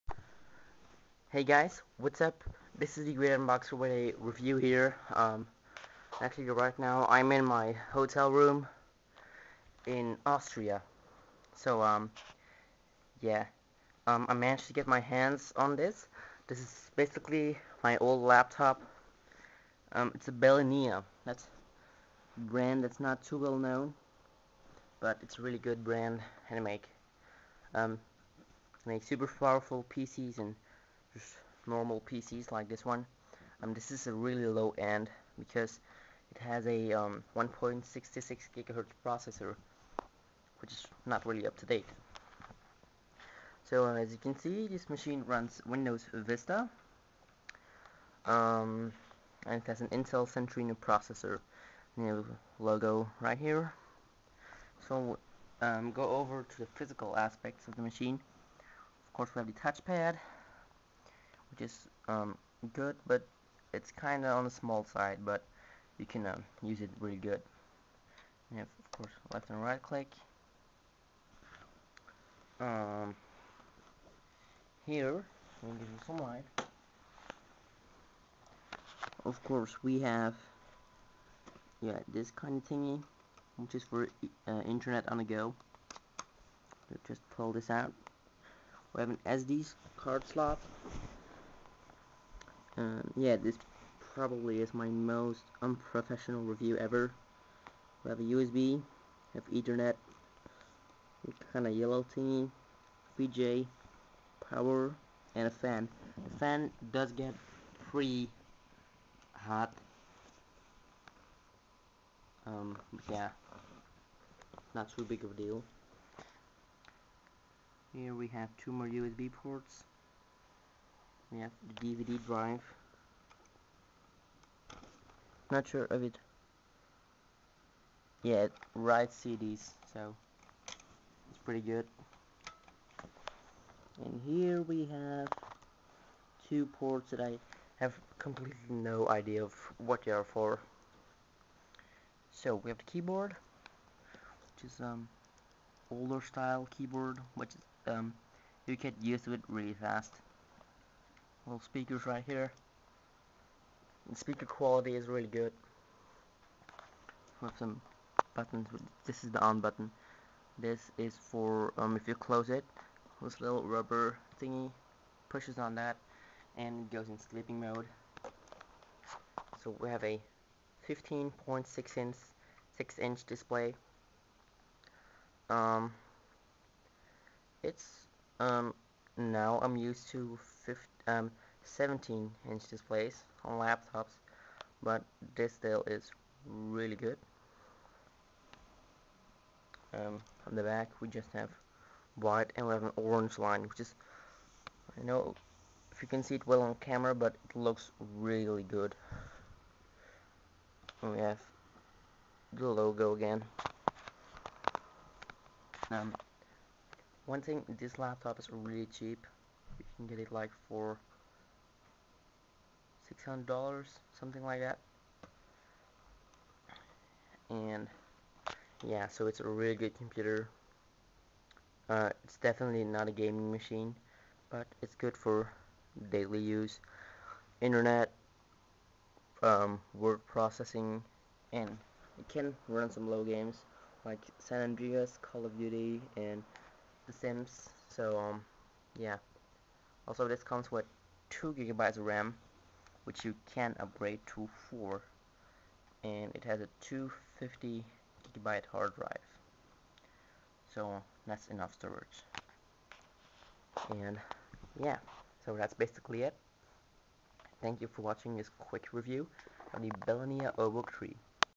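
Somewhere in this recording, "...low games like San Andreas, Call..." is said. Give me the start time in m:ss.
3:53.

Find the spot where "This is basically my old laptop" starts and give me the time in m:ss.
0:16.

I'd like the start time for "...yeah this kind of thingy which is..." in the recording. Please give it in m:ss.
1:21.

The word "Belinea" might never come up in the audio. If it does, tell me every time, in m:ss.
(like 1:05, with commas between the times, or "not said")
0:20, 4:20.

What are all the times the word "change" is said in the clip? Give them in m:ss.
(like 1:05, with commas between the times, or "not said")
not said.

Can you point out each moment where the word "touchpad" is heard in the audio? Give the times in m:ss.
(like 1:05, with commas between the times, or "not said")
0:59.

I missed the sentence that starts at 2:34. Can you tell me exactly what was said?
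The speaker quality is really good.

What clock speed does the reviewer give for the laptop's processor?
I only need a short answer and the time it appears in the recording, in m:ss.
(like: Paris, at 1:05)
1.66 GHz, at 0:37.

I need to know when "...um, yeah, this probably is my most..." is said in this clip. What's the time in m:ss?
1:32.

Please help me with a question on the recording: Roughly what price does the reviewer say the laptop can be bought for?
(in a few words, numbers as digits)
$600.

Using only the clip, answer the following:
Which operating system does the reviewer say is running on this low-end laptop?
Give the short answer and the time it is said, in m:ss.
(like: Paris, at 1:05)
Windows Vista, at 0:45.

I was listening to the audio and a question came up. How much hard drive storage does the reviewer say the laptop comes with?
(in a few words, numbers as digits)
250 GB.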